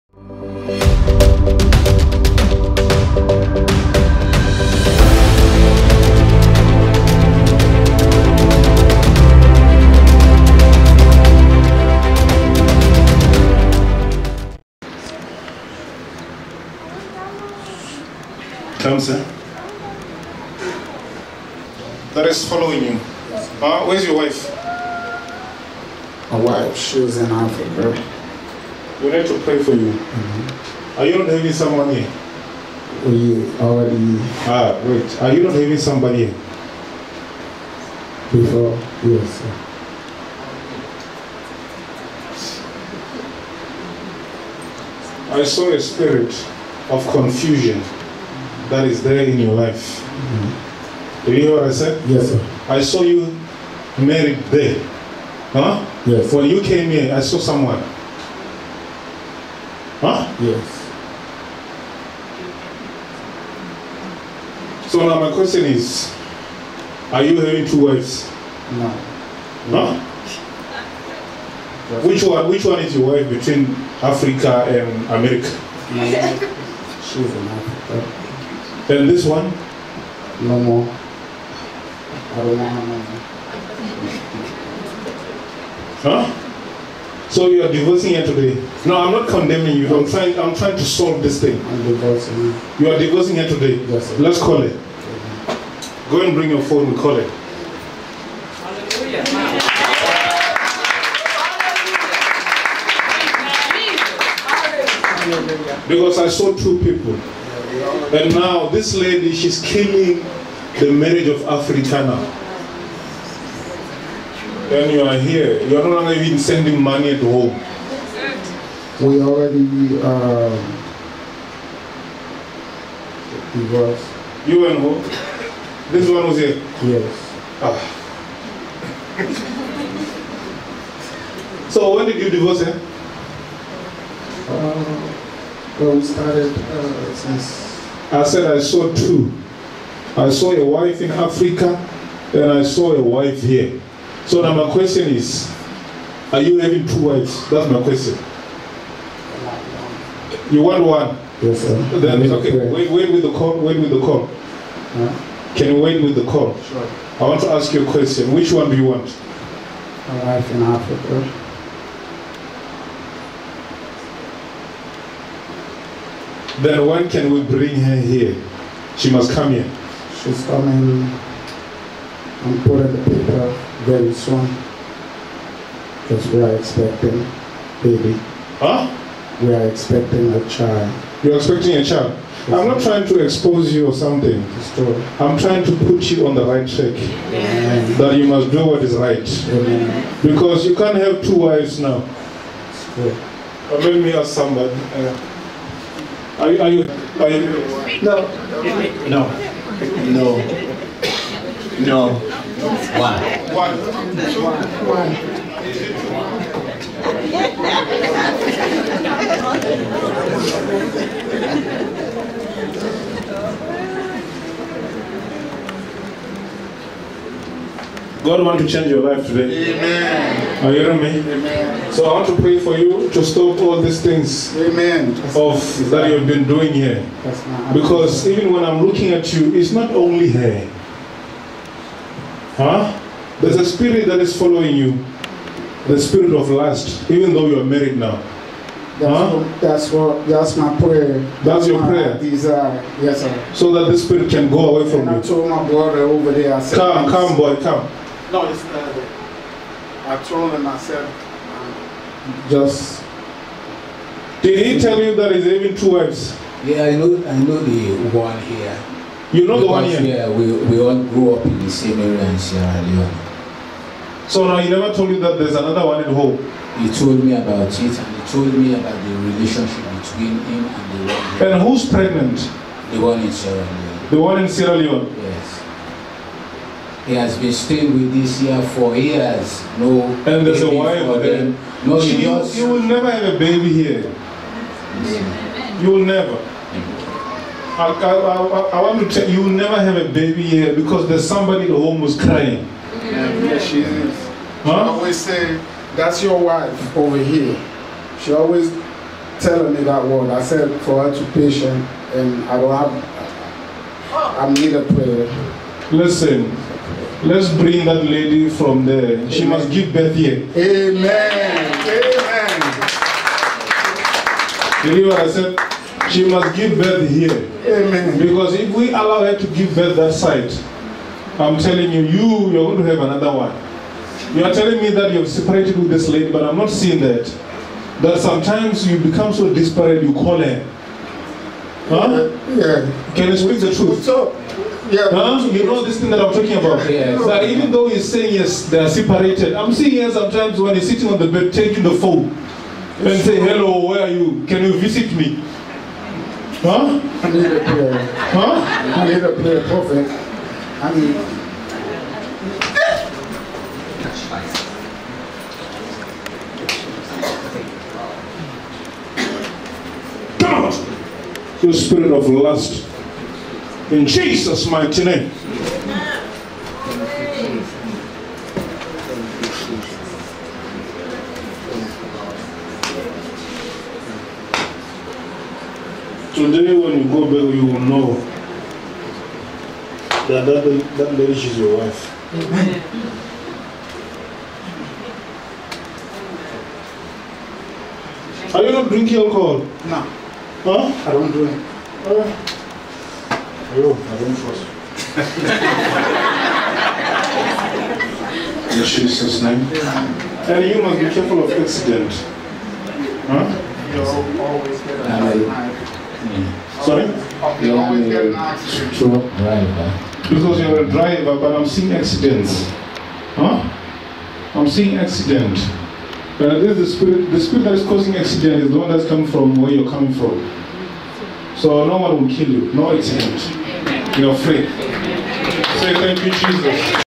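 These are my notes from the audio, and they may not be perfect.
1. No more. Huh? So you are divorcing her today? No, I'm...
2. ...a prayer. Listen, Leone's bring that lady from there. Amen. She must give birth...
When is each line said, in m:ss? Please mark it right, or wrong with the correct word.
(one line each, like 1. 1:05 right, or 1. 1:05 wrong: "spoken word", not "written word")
1. 1:20 right
2. 5:04 wrong: "Let", not "Leone".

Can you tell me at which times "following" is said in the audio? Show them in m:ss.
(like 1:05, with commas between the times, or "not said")
0:22, 3:54.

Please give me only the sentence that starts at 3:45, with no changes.
of that you've been doing here.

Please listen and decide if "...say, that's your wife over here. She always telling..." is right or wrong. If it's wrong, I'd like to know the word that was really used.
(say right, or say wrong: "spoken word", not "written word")
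right.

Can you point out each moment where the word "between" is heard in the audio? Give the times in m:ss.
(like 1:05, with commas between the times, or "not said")
1:13, 4:29.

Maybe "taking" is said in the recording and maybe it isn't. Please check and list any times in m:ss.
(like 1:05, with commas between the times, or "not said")
5:41.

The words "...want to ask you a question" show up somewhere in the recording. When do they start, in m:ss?
2:37.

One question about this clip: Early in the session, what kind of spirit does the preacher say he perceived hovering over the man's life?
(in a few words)
spirit of confusion.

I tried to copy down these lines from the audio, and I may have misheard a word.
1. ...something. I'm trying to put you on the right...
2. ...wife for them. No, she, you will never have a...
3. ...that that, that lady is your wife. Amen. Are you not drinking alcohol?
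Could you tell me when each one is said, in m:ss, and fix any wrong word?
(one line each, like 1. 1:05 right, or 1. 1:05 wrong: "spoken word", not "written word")
1. 3:03 right
2. 4:40 right
3. 6:20 right.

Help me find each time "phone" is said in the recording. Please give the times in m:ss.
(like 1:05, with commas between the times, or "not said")
1:36, 5:41.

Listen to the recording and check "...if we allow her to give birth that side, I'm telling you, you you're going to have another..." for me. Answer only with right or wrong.
right.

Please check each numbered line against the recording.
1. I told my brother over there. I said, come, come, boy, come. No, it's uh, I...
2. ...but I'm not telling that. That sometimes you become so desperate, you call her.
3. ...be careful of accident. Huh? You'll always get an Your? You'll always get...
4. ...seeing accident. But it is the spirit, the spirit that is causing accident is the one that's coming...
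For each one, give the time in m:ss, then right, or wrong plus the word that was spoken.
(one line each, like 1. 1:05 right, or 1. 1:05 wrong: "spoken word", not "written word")
1. 4:05 right
2. 5:26 wrong: "seeing", not "telling"
3. 6:40 wrong: "Sorry", not "Your"
4. 6:54 right.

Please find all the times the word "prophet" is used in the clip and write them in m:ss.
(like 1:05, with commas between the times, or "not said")
5:49.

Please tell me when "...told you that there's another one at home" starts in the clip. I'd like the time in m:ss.
4:24.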